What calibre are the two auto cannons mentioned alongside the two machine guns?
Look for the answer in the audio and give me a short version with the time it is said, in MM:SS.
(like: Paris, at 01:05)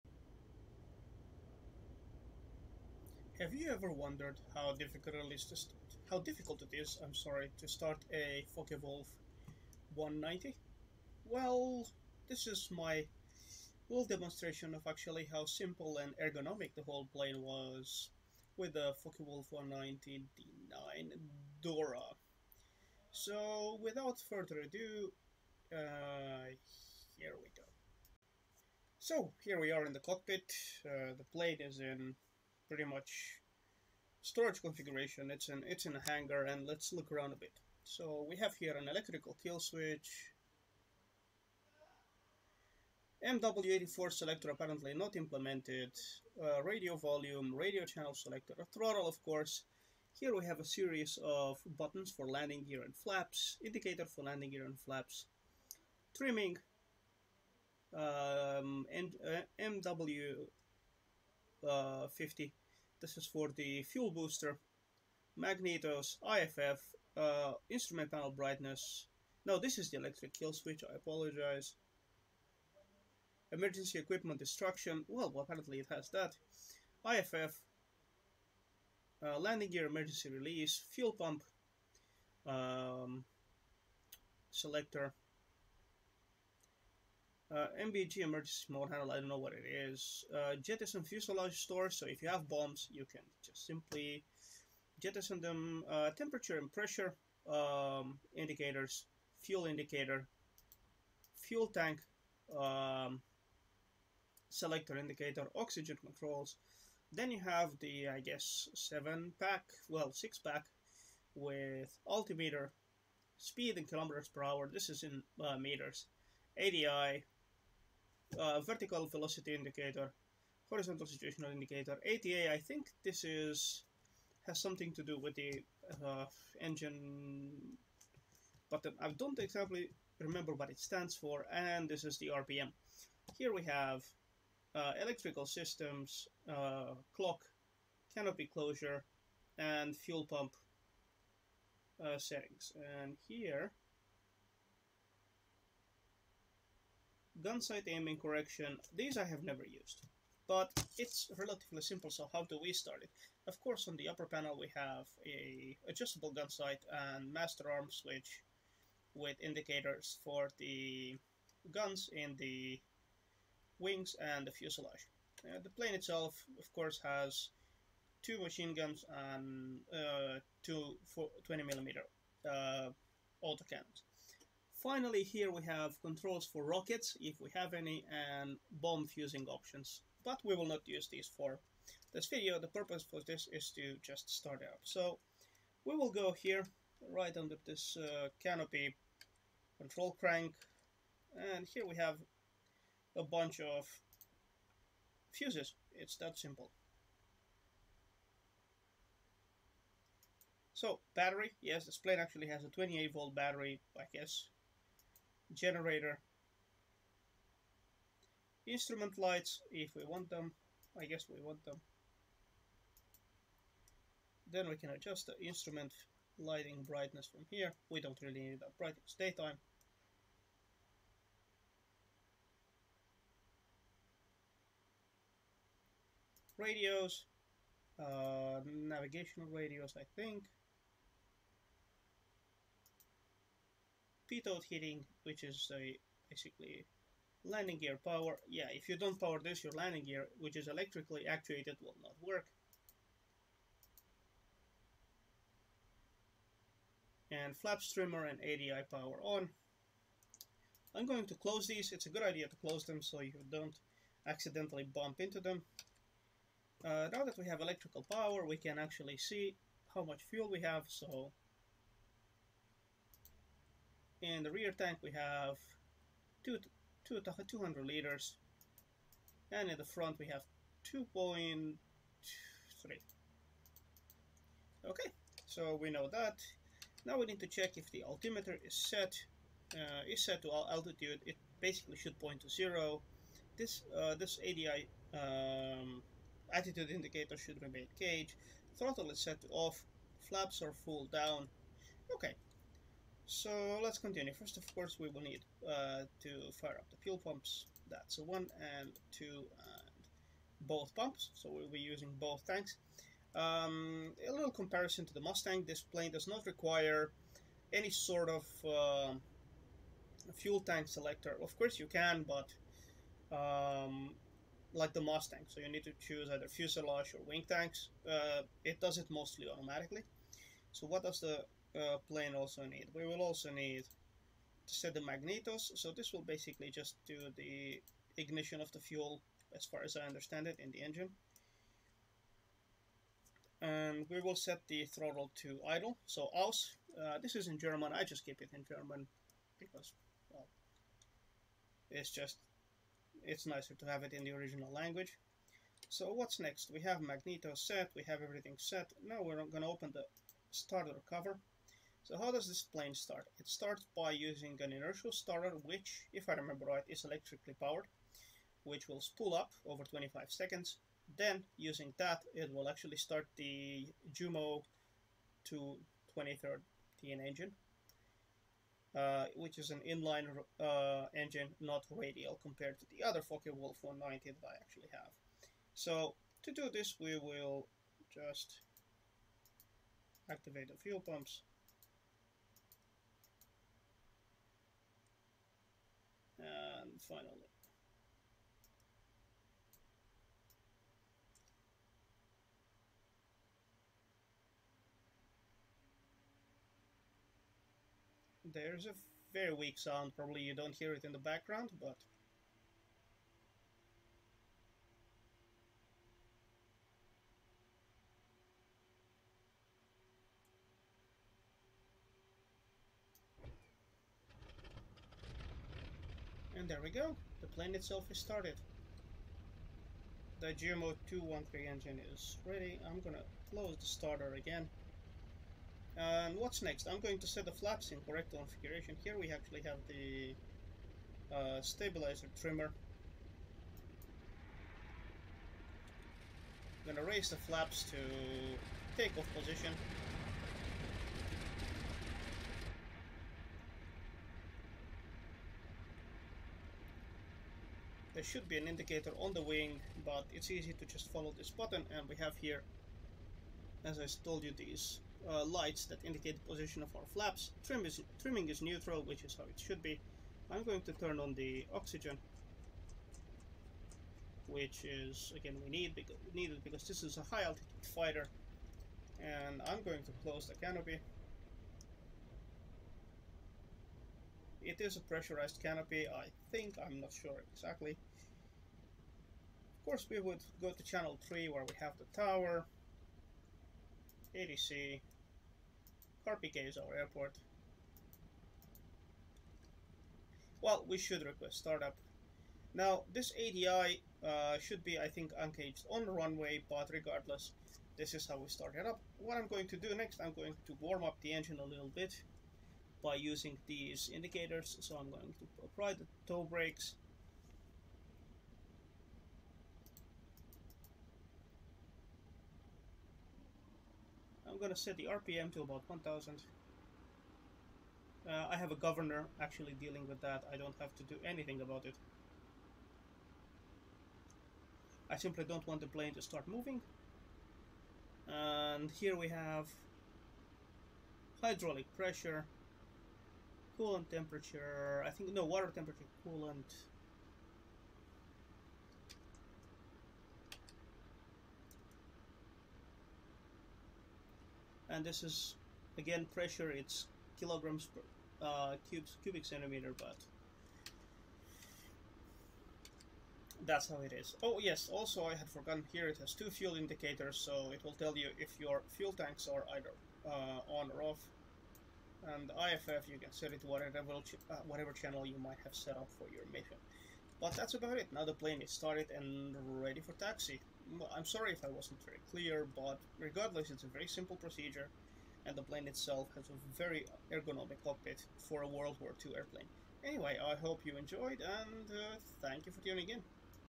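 20 millimeter, at 02:51.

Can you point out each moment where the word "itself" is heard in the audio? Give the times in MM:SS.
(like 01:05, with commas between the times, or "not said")
02:45, 06:57, 09:35.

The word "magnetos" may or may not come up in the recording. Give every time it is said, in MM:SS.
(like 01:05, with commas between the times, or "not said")
01:05, 05:25, 05:47.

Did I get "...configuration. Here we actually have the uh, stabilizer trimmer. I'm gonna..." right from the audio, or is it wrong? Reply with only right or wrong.
right.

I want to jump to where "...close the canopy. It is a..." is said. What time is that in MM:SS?
07:50.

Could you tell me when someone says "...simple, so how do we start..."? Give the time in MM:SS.
02:31.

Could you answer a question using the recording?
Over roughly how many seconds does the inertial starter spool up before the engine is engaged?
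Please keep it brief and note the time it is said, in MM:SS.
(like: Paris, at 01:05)
25 seconds, at 05:59.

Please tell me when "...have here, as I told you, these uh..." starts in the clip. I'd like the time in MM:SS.
07:32.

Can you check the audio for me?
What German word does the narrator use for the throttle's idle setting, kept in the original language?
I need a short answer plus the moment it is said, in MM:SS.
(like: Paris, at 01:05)
aus, at 05:36.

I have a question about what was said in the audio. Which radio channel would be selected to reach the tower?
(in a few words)
channel 3.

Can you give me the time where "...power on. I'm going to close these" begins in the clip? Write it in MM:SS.
04:08.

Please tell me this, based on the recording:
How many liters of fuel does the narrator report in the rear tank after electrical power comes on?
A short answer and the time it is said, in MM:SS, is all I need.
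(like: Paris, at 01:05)
200 liters, at 04:27.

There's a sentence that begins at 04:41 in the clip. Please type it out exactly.
It basically should point to zero.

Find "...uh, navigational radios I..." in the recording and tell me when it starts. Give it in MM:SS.
03:47.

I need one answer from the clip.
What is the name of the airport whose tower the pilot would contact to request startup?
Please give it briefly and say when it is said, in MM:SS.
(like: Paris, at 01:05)
Carpiquet, at 08:06.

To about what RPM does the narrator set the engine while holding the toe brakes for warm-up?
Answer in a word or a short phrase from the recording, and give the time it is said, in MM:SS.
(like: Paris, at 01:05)
1000, at 08:35.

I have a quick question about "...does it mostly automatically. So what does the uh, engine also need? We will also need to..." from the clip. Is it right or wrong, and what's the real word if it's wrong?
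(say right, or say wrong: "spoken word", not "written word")
wrong: "plane", not "engine".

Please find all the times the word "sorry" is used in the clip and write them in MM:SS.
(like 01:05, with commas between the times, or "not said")
00:07, 09:31.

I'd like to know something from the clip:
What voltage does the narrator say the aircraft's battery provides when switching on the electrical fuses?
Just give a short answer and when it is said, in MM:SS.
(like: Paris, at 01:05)
28 volt, at 03:22.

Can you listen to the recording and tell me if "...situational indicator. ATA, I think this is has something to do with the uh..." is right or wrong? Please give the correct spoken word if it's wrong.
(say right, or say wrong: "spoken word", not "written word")
right.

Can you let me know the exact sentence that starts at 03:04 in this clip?
So we will go here, right under this uh, canopy control crank, and here we have a bunch of fuses.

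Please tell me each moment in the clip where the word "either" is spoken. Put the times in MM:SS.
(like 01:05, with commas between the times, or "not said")
05:16, 09:19.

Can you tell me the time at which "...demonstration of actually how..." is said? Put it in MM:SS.
00:14.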